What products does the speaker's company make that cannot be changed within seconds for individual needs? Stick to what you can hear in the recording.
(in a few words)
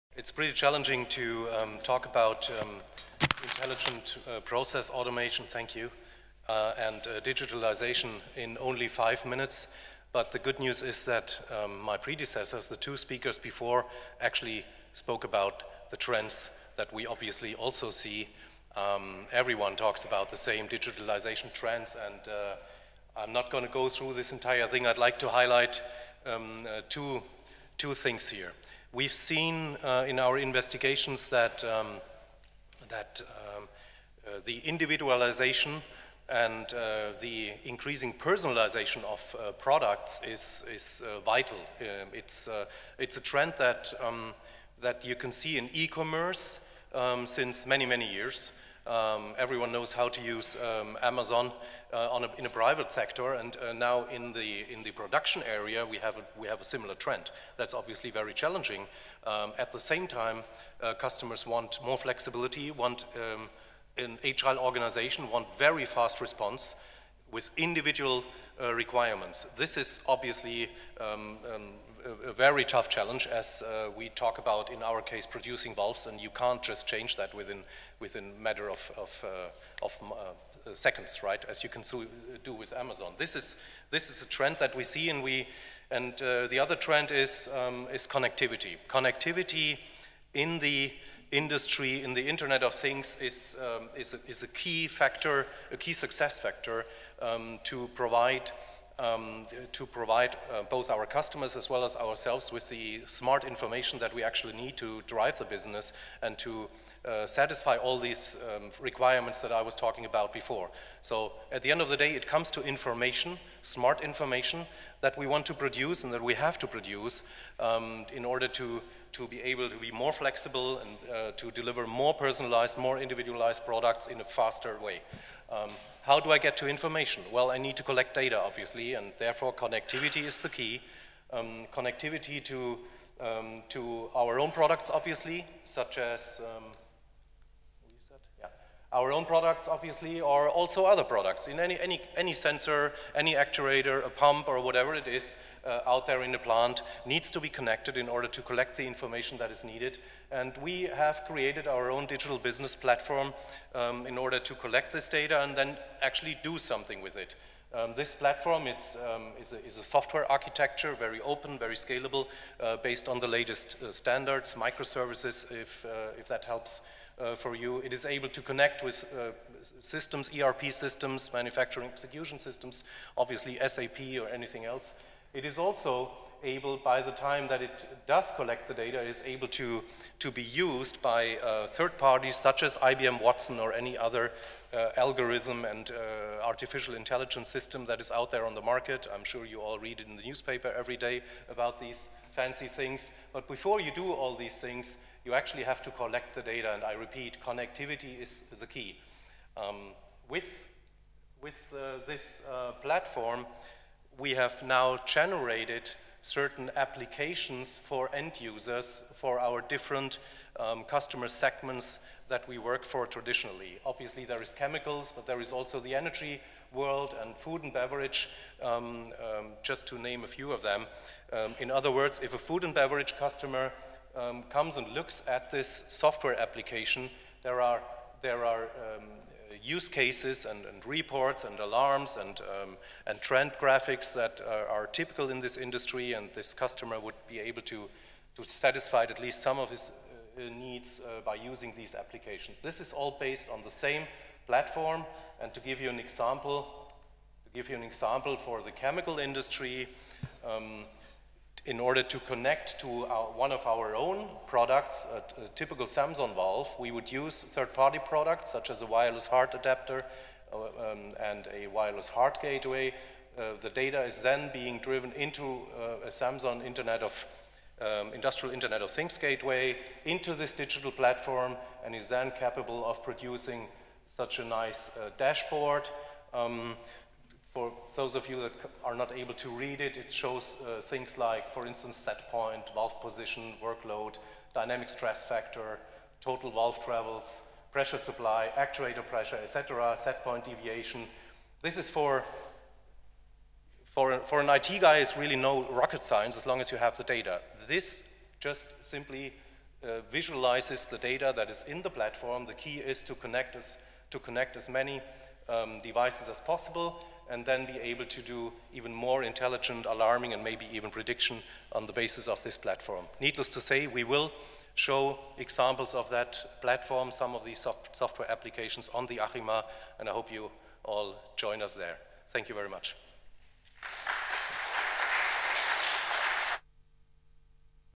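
valves.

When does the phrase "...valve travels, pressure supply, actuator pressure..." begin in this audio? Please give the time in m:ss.
4:46.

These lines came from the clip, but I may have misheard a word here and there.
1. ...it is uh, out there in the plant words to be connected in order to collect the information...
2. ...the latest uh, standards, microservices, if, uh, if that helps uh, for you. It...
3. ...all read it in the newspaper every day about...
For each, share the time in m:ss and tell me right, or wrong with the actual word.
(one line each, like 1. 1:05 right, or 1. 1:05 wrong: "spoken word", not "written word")
1. 2:24 wrong: "needs", not "words"
2. 2:43 right
3. 3:09 right.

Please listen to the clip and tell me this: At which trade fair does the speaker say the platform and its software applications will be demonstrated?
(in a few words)
ACHEMA.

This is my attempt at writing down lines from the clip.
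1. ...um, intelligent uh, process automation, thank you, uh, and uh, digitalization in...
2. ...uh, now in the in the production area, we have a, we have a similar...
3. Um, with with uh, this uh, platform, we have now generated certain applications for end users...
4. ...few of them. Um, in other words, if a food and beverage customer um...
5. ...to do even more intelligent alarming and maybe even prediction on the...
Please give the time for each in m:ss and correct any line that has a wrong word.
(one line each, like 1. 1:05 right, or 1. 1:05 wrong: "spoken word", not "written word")
1. 0:02 right
2. 0:53 right
3. 3:19 right
4. 3:40 right
5. 5:08 right.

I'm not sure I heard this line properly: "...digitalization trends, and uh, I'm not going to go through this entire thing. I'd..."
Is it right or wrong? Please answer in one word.
right.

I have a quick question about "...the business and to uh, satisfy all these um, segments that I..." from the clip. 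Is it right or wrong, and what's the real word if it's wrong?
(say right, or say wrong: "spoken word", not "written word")
wrong: "requirements", not "segments".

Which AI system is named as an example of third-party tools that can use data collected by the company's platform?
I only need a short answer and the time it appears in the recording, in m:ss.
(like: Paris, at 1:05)
IBM Watson, at 3:02.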